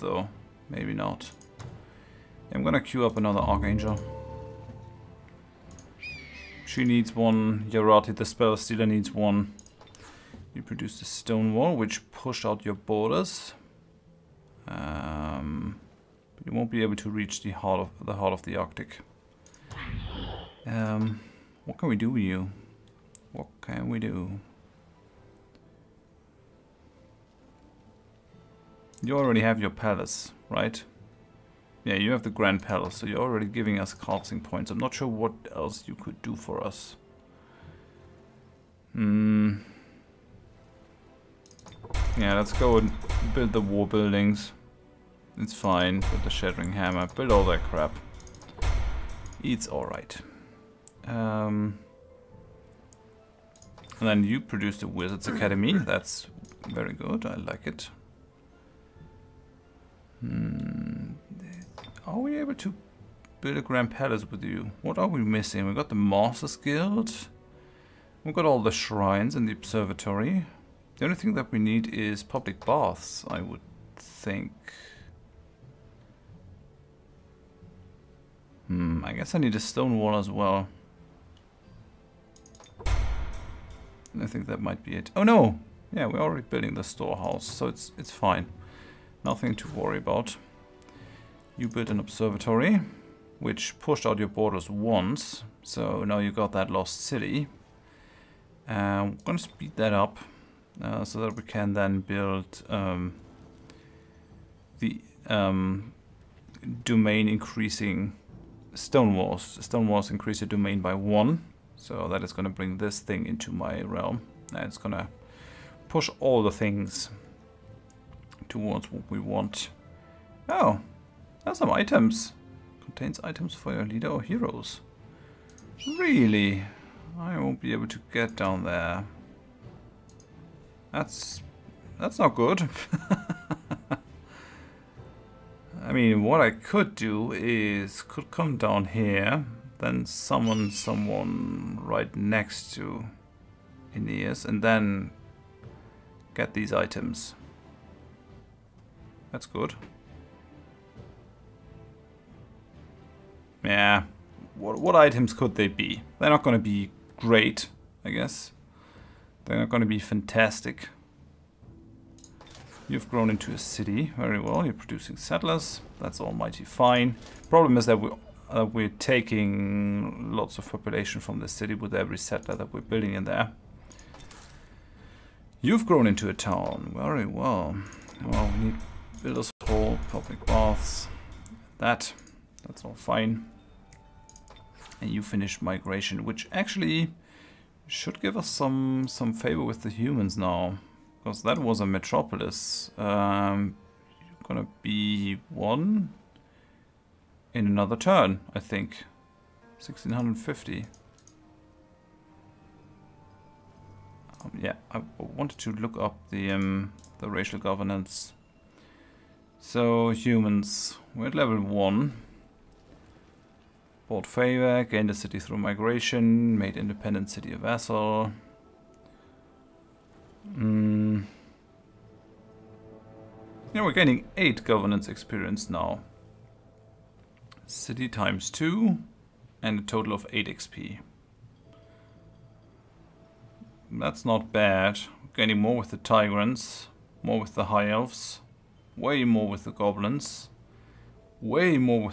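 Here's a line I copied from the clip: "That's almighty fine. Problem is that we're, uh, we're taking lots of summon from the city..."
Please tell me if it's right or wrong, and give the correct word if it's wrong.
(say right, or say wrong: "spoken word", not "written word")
wrong: "population", not "summon".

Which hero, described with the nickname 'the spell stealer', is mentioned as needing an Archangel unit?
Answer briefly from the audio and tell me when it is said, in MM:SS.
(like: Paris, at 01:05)
Yarati, at 00:07.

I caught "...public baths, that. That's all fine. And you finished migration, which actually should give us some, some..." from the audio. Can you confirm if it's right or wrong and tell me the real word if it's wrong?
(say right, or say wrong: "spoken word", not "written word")
right.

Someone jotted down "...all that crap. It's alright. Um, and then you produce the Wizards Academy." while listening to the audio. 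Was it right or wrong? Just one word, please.
right.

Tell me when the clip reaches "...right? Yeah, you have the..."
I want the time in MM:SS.
00:30.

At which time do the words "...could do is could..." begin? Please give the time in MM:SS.
02:16.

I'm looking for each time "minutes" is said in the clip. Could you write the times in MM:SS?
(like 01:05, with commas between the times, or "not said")
not said.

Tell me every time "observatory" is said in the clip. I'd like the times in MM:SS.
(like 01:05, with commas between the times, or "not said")
01:09, 01:31.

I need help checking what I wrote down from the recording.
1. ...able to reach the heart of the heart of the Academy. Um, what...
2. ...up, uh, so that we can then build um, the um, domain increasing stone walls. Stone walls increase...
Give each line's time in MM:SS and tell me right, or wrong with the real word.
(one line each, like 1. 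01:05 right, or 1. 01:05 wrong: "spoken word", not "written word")
1. 00:16 wrong: "Arctic", not "Academy"
2. 01:39 right.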